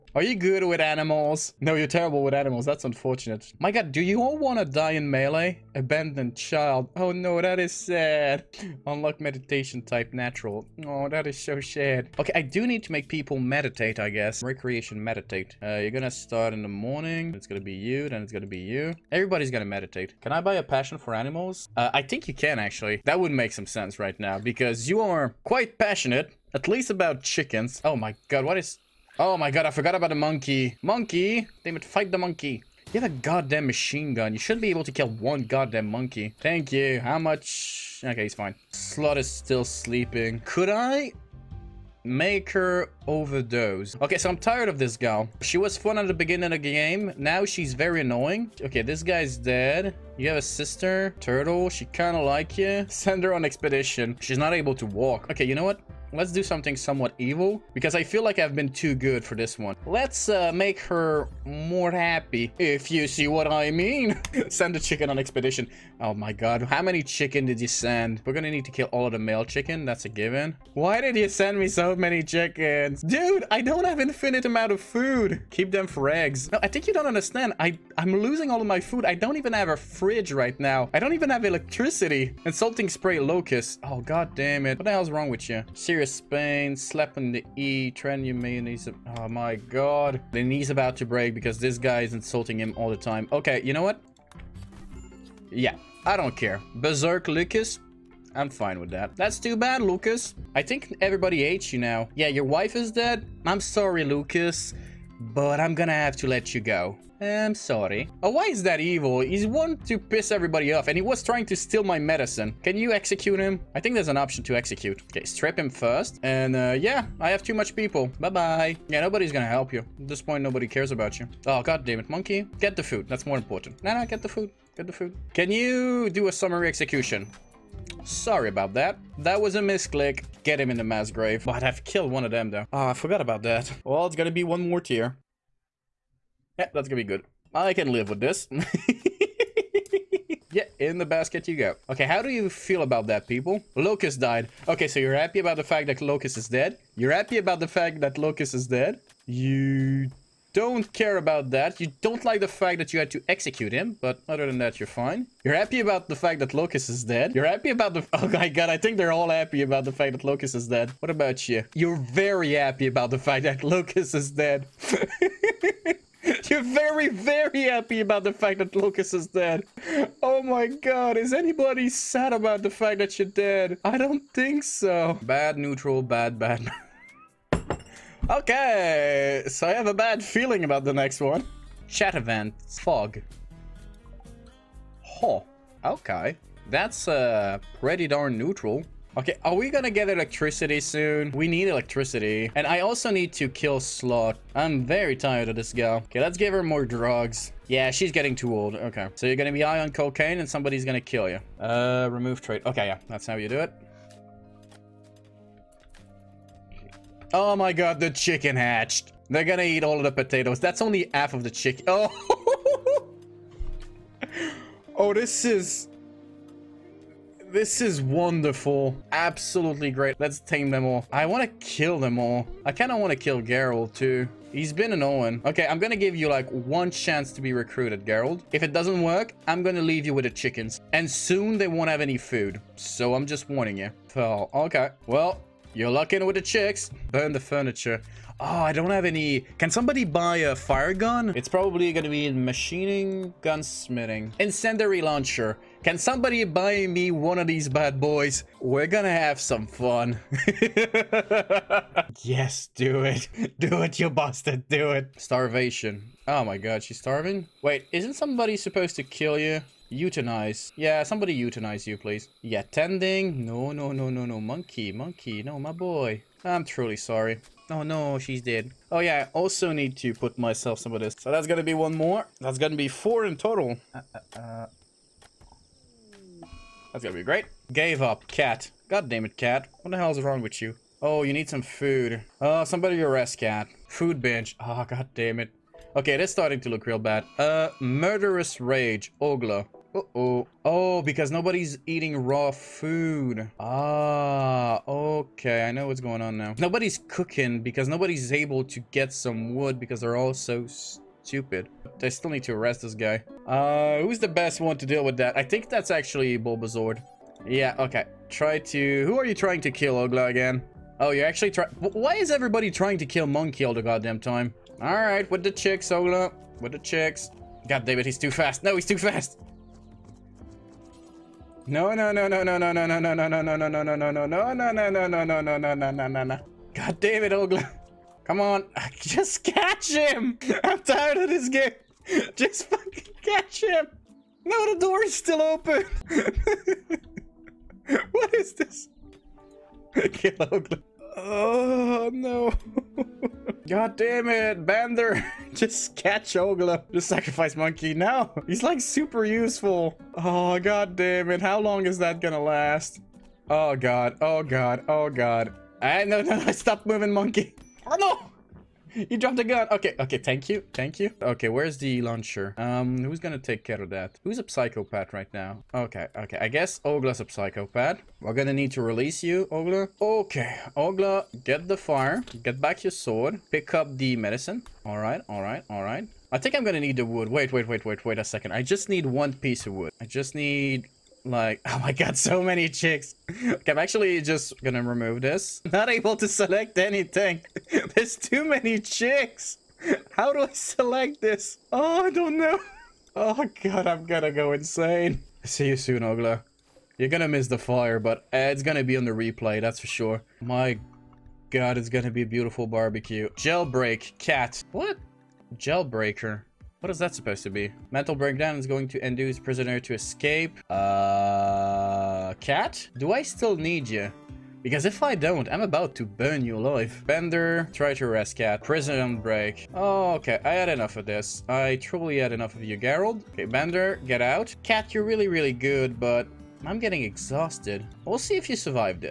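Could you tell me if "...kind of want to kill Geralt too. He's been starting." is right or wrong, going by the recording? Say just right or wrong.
wrong.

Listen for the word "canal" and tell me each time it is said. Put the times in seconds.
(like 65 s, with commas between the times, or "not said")
not said.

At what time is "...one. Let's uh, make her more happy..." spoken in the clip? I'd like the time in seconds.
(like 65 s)
59 s.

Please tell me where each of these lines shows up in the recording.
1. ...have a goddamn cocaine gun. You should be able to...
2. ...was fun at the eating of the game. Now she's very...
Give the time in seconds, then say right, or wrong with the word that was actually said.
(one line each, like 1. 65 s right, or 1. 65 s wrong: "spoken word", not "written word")
1. 32 s wrong: "machine", not "cocaine"
2. 45 s wrong: "beginning", not "eating".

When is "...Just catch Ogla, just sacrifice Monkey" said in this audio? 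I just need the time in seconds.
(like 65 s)
345 s.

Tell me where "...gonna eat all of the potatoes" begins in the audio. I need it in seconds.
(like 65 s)
209 s.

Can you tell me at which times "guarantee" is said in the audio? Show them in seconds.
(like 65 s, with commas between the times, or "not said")
not said.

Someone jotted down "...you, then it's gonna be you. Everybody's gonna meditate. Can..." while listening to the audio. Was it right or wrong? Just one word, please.
right.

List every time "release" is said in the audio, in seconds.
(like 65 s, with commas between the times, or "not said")
368 s.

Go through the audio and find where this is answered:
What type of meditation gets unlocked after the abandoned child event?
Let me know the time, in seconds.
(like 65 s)
10 s.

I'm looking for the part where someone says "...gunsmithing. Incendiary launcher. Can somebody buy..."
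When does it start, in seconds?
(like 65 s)
243 s.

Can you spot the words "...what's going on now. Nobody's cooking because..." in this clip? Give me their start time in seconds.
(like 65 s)
295 s.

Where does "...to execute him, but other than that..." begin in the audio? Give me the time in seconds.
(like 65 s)
153 s.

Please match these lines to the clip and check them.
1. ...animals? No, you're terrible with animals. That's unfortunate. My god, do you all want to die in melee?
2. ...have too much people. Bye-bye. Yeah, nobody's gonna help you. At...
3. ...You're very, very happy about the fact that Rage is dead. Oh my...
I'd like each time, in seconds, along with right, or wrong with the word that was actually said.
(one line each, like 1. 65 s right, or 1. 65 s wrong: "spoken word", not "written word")
1. 0 s right
2. 117 s right
3. 166 s wrong: "Lucas", not "Rage".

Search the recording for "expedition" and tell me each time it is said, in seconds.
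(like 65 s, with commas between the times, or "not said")
53 s, 65 s.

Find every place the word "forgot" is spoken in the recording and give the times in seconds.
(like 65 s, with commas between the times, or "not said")
29 s, 132 s.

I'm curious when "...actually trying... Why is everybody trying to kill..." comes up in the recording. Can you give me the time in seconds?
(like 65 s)
311 s.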